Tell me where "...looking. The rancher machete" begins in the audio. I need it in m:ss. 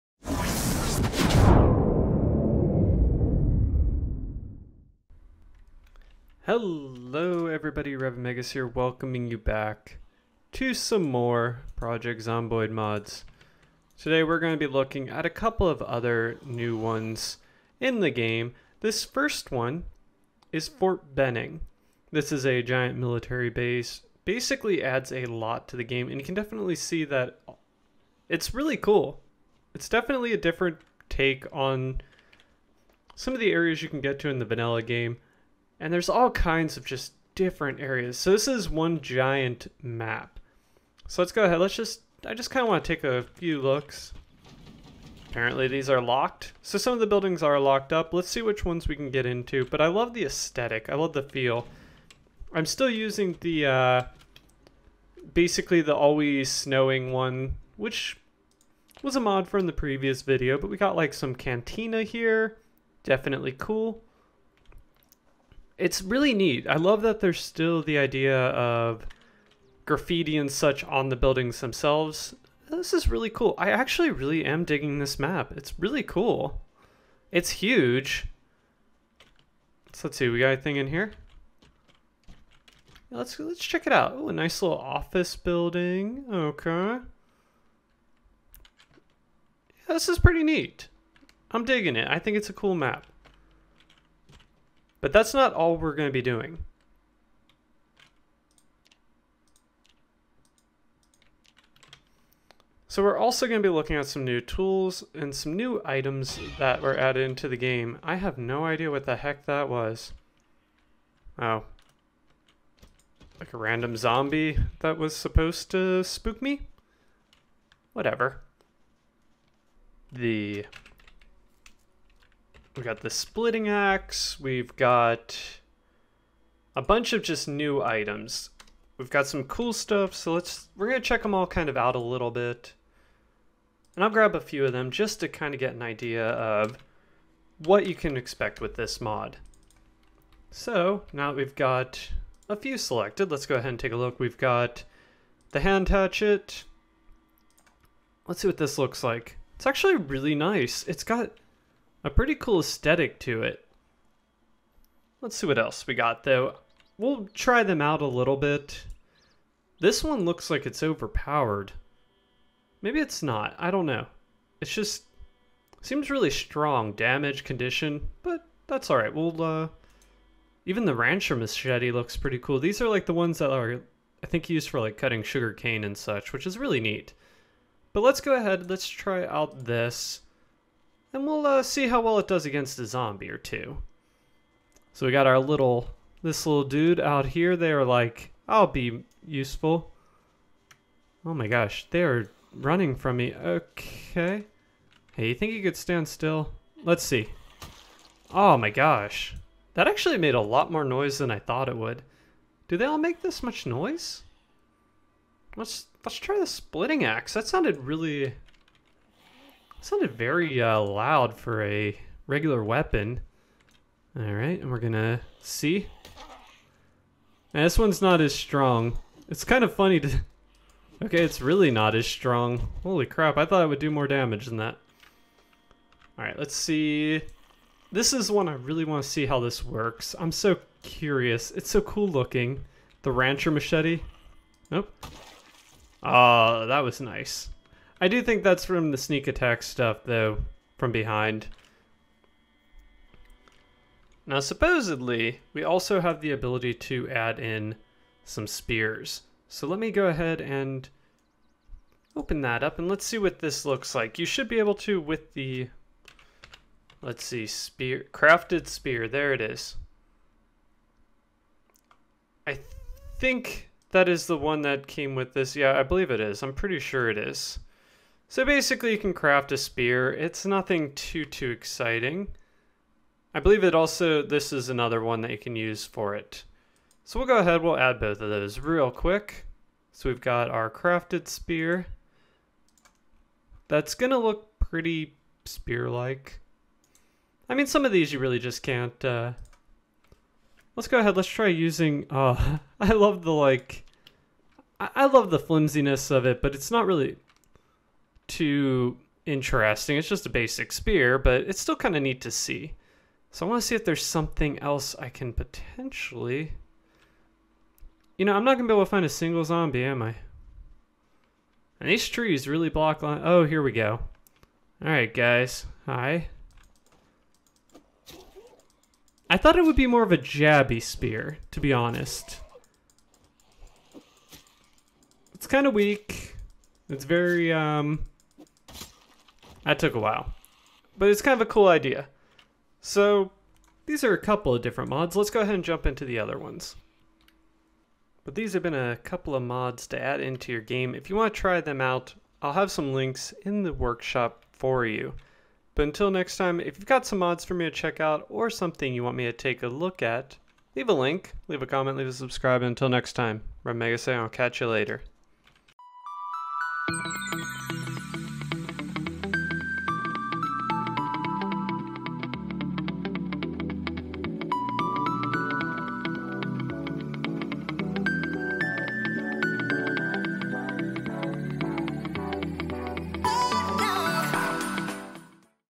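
3:52.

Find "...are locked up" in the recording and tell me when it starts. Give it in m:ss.
0:47.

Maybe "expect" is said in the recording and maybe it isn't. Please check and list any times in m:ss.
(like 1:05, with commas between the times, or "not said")
2:18.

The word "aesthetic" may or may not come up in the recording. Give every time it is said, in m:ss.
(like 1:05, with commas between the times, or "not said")
0:50, 2:32.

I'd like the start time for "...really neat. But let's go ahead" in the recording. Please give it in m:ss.
2:56.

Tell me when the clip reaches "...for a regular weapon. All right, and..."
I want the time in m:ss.
3:31.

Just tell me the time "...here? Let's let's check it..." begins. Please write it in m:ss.
1:20.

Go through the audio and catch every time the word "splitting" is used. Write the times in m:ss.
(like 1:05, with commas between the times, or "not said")
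2:03, 3:26.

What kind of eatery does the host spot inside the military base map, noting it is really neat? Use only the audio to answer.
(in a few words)
cantina.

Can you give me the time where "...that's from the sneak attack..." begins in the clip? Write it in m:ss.
3:58.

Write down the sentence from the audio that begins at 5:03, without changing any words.
So I want to see if there's something else I can potentially...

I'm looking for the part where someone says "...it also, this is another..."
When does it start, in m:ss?
4:33.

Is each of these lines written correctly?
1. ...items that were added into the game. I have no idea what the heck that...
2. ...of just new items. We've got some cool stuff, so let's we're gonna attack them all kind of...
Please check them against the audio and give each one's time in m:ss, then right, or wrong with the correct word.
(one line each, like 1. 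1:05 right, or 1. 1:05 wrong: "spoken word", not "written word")
1. 1:45 right
2. 2:07 wrong: "check", not "attack".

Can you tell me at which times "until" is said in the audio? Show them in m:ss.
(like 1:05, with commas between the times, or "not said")
5:45, 5:52.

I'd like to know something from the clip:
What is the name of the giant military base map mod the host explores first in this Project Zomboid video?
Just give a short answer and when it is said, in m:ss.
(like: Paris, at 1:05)
Fort Benning, at 0:20.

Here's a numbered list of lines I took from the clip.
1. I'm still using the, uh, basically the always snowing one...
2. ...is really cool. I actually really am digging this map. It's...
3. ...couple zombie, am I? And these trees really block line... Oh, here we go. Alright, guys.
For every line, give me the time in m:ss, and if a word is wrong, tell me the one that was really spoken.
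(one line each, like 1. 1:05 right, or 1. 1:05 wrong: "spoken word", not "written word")
1. 0:52 right
2. 1:12 right
3. 5:09 wrong: "single", not "couple".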